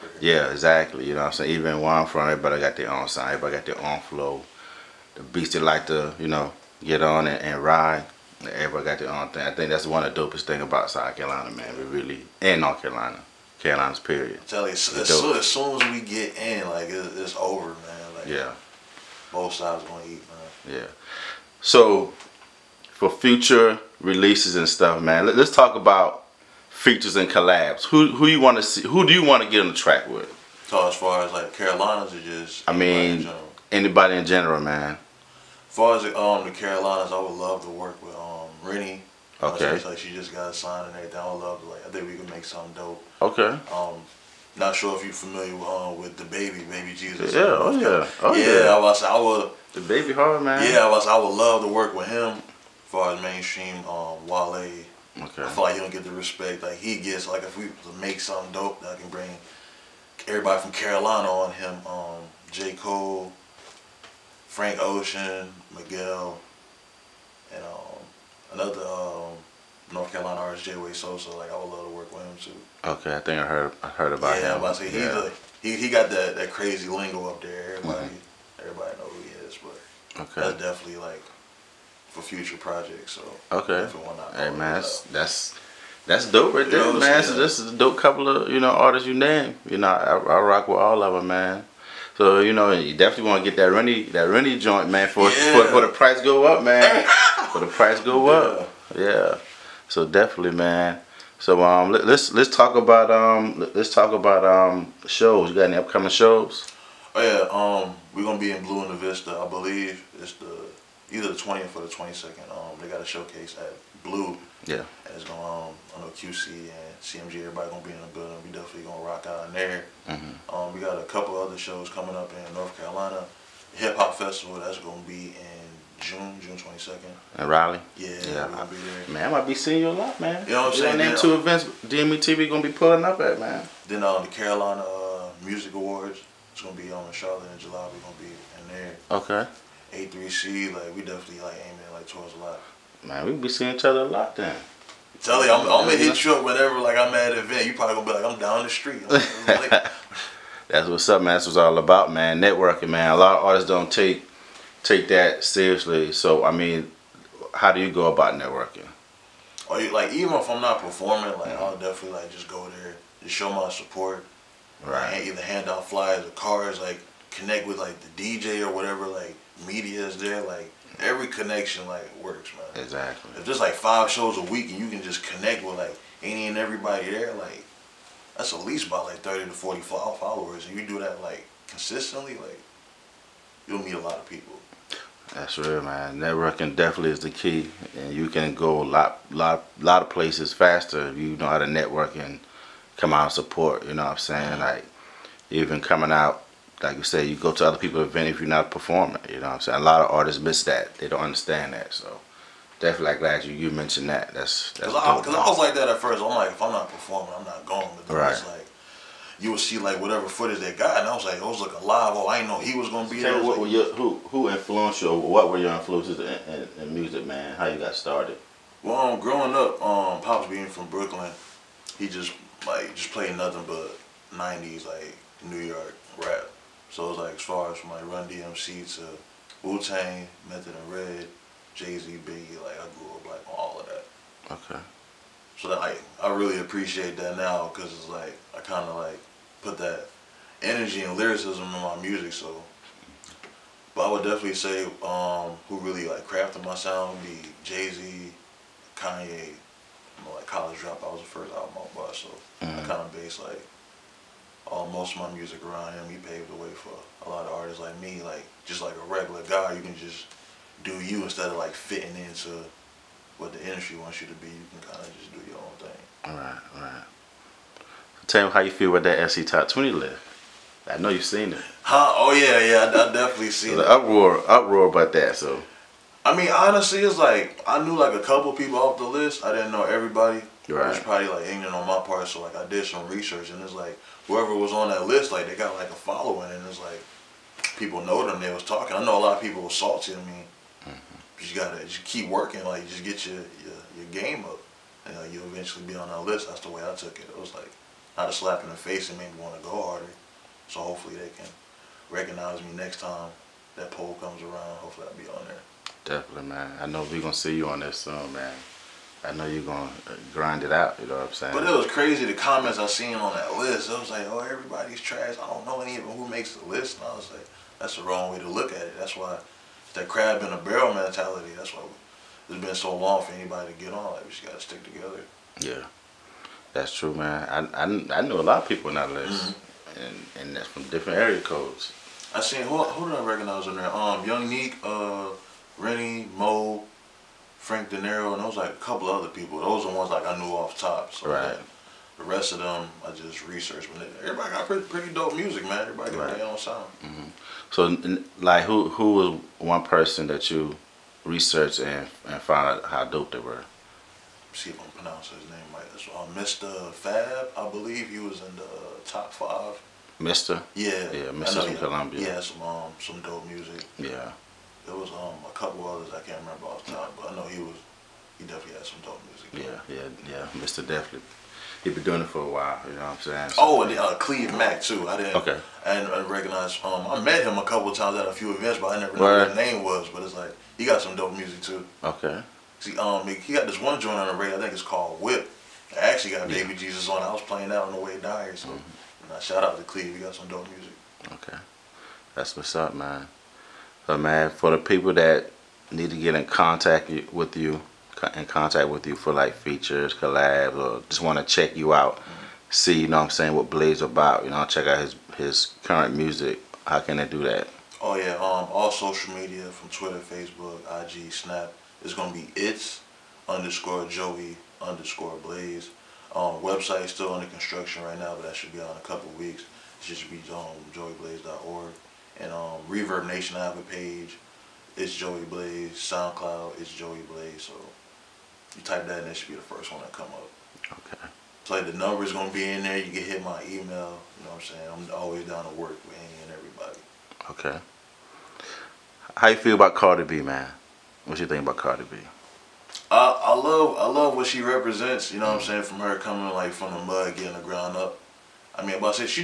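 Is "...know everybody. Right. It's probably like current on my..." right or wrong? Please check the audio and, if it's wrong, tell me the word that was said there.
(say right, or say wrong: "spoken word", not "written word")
wrong: "ignorant", not "current".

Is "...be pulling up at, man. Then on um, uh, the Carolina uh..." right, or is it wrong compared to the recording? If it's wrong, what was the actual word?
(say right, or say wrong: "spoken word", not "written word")
right.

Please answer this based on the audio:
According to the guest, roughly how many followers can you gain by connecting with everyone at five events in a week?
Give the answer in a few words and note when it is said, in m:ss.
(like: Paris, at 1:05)
30 to 40, at 2:59.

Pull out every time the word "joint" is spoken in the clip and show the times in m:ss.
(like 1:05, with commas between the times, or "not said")
1:34, 6:23.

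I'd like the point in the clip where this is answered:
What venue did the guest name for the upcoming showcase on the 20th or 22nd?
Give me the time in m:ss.
1:48.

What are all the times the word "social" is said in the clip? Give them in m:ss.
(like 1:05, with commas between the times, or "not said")
6:48.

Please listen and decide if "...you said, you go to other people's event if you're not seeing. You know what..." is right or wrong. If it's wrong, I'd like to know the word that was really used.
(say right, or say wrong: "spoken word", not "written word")
wrong: "performing", not "seeing".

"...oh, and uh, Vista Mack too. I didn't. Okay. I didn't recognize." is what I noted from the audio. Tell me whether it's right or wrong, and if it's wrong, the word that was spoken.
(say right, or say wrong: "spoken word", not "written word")
wrong: "Cleve", not "Vista".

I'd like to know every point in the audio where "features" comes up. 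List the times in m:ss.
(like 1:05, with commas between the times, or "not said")
0:26, 6:39.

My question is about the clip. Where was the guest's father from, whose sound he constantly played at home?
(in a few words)
Brooklyn.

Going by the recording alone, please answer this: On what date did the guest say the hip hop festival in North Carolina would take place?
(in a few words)
June 22.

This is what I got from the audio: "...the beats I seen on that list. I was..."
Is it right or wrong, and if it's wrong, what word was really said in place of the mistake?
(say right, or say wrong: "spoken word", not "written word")
wrong: "comments", not "beats".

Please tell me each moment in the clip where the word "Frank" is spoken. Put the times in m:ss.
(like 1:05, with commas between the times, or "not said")
1:04, 5:37.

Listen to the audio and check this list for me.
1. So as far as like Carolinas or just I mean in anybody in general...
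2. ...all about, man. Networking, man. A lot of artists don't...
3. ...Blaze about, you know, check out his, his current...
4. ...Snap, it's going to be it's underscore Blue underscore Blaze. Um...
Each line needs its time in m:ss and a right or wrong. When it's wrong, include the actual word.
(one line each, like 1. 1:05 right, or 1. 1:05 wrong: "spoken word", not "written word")
1. 0:30 right
2. 2:31 right
3. 6:43 right
4. 6:51 wrong: "Joey", not "Blue".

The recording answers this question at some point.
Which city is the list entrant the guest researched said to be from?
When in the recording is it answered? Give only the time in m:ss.
6:01.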